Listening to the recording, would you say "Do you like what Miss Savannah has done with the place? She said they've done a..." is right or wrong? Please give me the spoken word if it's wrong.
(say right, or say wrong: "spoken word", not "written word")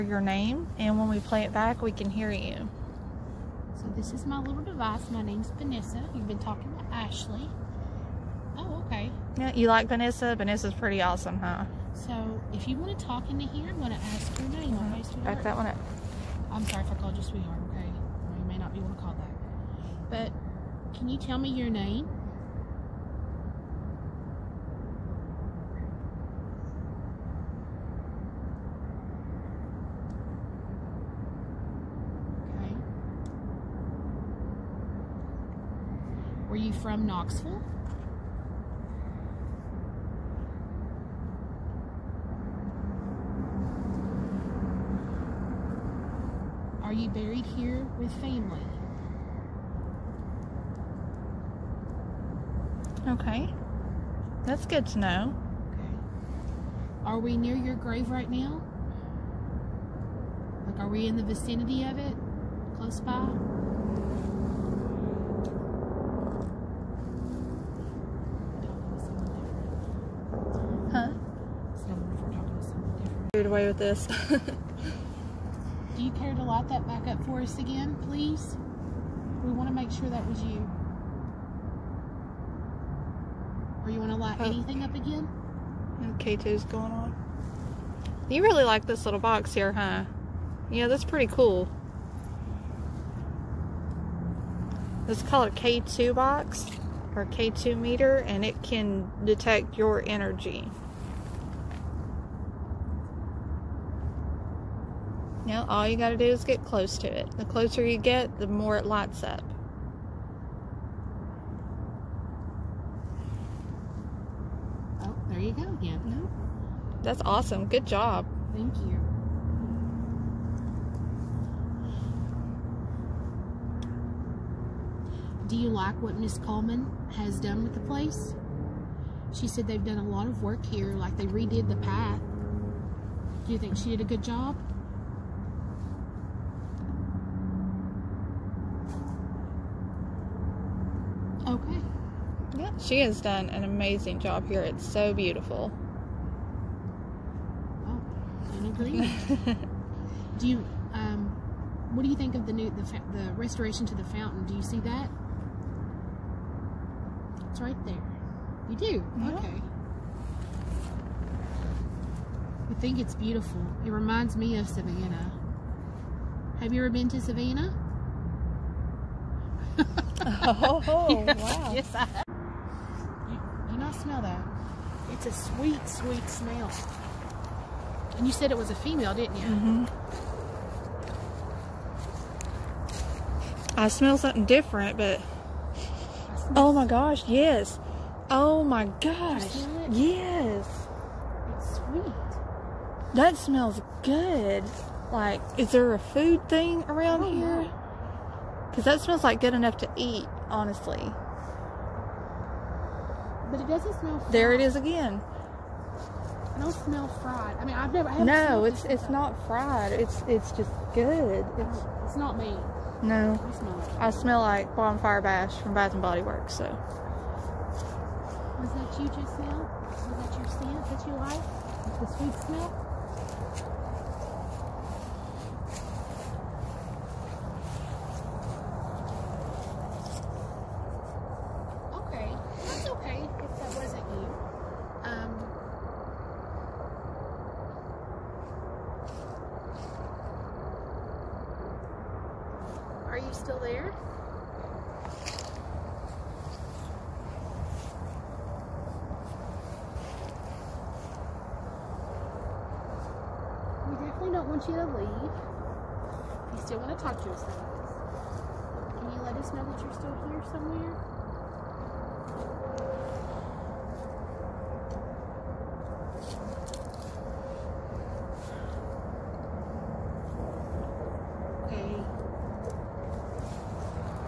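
wrong: "Coleman", not "Savannah".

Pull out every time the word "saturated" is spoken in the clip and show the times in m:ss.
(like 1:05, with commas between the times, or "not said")
not said.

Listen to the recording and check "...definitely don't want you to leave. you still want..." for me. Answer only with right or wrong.
right.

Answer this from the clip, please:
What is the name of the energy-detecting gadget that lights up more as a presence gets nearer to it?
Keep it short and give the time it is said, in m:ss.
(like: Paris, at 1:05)
K2 meter, at 1:37.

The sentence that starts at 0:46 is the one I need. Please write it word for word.
Are you buried here with family?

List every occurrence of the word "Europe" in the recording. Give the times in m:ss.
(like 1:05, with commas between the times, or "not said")
not said.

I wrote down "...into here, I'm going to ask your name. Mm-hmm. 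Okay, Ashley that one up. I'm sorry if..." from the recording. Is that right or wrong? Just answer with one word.
wrong.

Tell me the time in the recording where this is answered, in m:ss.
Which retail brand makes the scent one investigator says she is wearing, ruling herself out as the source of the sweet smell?
3:35.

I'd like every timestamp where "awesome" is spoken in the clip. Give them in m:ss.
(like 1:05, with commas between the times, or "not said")
0:11, 1:57.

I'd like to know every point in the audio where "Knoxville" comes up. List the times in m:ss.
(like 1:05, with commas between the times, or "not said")
0:37.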